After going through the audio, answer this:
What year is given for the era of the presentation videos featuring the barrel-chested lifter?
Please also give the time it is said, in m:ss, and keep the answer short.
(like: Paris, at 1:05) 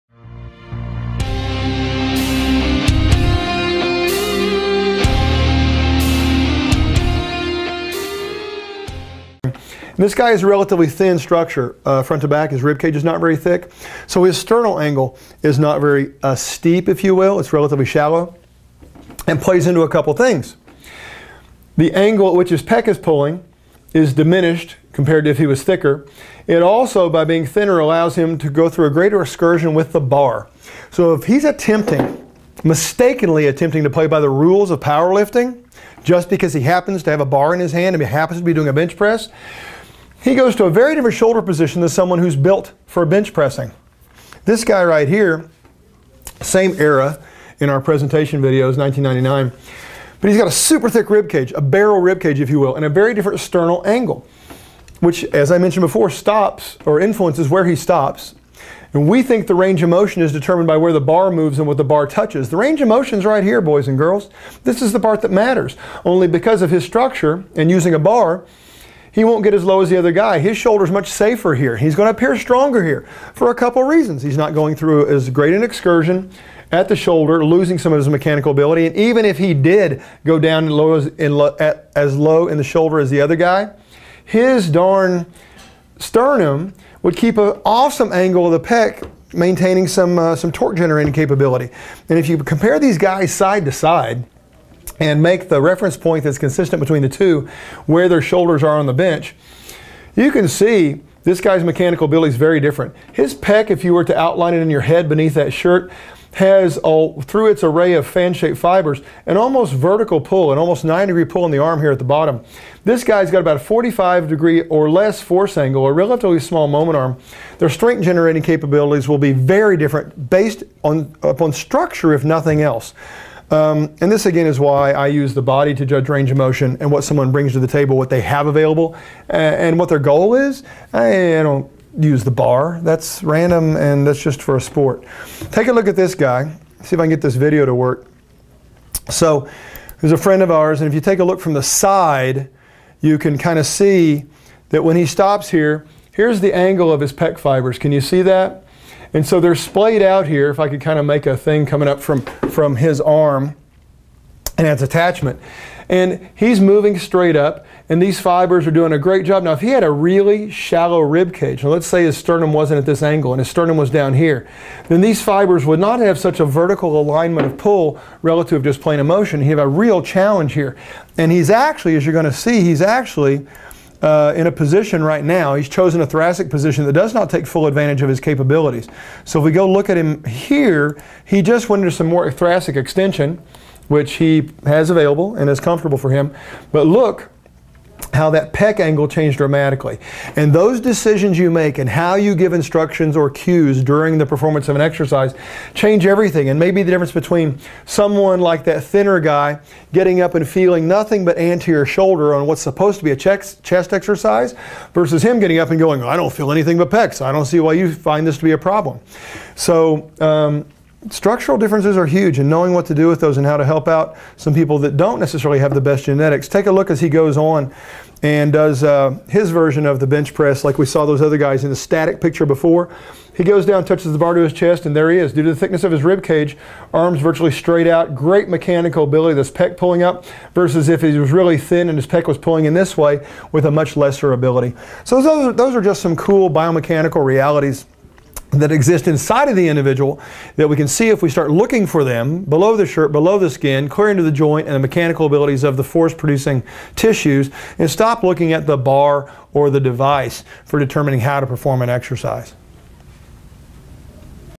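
1999, at 0:48.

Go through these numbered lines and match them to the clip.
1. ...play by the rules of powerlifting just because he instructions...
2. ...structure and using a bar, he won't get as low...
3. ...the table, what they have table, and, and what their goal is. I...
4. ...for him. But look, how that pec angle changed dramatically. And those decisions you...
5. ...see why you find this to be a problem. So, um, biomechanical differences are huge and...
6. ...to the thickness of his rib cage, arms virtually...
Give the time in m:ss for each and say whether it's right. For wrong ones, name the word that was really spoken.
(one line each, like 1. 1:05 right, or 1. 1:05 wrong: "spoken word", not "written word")
1. 0:33 wrong: "happens", not "instructions"
2. 1:06 right
3. 2:07 wrong: "available", not "table"
4. 3:05 right
5. 3:27 wrong: "structural", not "biomechanical"
6. 3:45 right.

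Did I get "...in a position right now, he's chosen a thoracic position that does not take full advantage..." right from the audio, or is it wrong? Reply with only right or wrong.
right.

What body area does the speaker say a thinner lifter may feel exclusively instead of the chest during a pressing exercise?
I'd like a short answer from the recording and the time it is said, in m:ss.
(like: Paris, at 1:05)
Anterior shoulder, at 3:21.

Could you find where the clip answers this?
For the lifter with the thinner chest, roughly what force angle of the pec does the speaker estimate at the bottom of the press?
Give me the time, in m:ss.
1:53.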